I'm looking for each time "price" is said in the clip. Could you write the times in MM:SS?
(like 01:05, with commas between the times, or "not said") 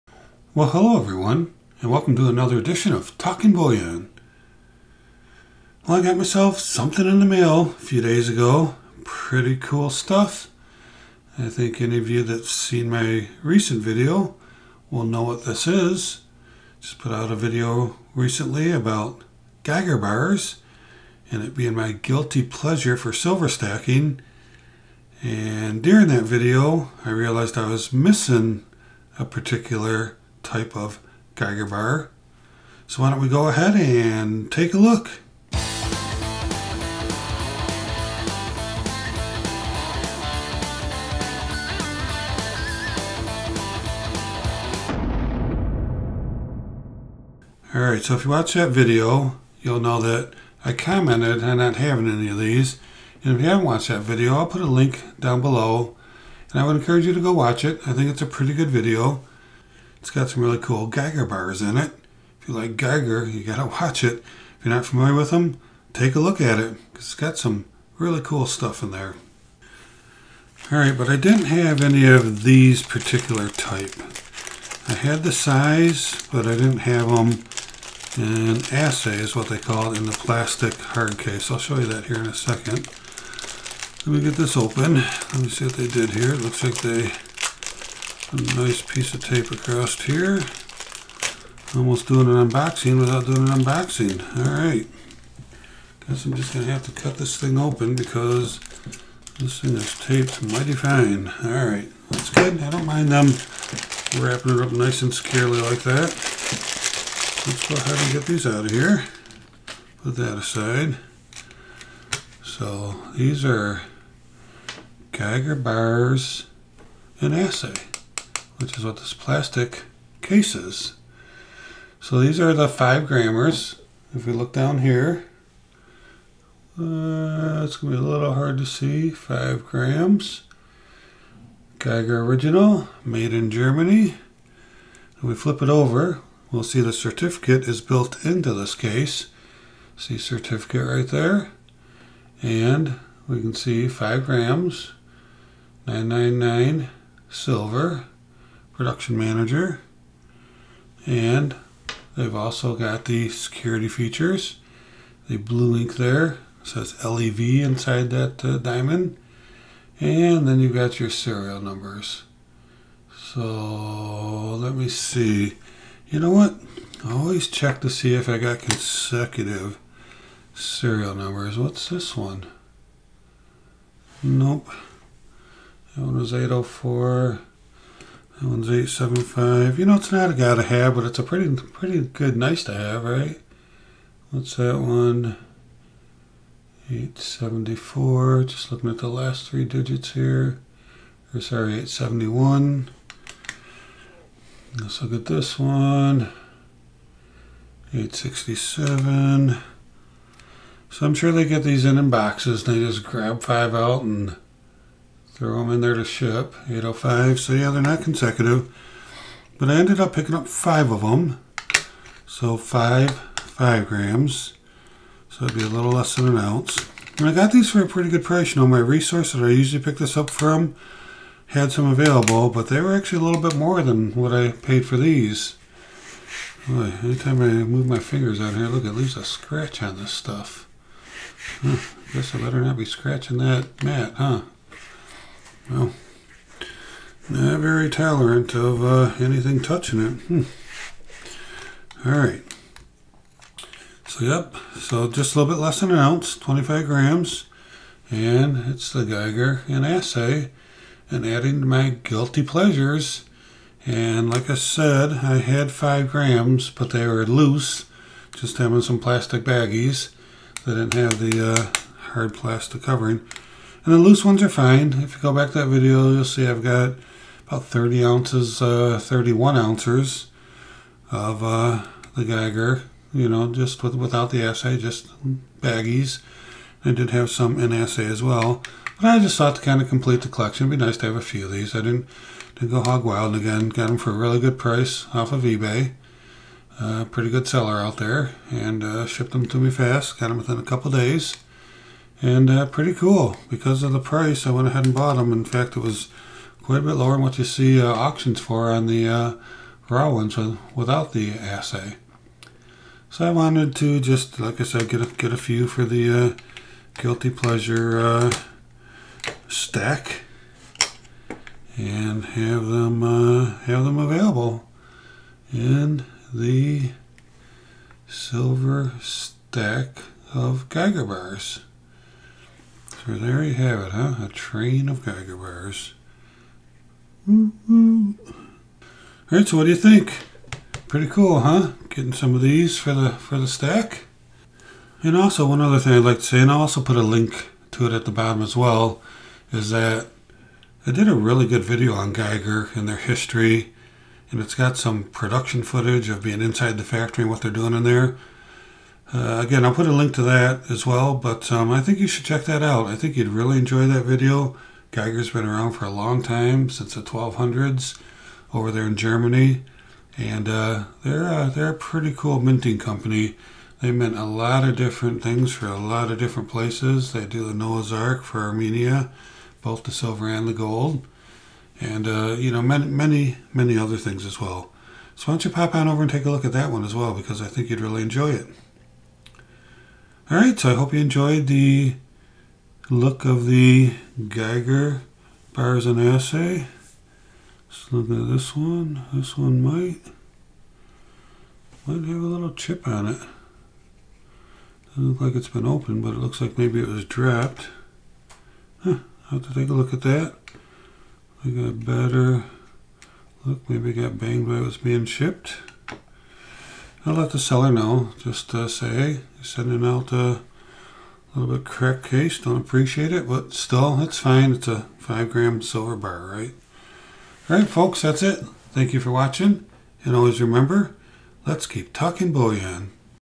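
03:38, 04:44, 04:53.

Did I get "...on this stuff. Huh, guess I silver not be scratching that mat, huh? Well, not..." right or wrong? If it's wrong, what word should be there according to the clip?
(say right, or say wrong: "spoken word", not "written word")
wrong: "better", not "silver".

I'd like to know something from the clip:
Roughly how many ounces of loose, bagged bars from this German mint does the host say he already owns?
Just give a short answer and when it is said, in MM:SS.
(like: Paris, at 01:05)
31 ounces, at 04:29.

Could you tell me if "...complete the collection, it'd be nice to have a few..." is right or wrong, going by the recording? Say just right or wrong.
right.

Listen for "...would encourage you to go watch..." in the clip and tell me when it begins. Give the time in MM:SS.
00:56.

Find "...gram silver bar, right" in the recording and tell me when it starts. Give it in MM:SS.
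06:55.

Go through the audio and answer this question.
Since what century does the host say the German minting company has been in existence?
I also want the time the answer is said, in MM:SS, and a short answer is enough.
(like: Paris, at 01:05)
the 1200s, at 05:56.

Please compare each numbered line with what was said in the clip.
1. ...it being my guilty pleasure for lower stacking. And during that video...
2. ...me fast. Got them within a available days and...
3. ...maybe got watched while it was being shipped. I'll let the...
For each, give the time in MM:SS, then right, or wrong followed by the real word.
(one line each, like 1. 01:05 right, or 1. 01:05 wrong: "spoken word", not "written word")
1. 00:21 wrong: "silver", not "lower"
2. 04:49 wrong: "couple", not "available"
3. 06:43 wrong: "banged", not "watched".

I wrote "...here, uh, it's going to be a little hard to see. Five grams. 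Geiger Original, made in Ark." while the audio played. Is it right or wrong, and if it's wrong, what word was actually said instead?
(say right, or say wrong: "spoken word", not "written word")
wrong: "Germany", not "Ark".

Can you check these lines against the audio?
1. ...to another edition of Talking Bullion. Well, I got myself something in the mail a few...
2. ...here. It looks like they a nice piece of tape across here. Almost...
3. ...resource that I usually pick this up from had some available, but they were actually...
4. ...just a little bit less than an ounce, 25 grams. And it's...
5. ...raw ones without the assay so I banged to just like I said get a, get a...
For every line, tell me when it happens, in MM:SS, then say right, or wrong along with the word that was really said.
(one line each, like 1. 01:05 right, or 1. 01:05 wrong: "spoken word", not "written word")
1. 00:02 right
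2. 01:26 right
3. 03:38 right
4. 04:05 right
5. 04:59 wrong: "wanted", not "banged".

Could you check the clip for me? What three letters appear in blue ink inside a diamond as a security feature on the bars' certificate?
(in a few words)
LEV.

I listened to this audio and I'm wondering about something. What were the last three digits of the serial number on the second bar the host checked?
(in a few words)
875.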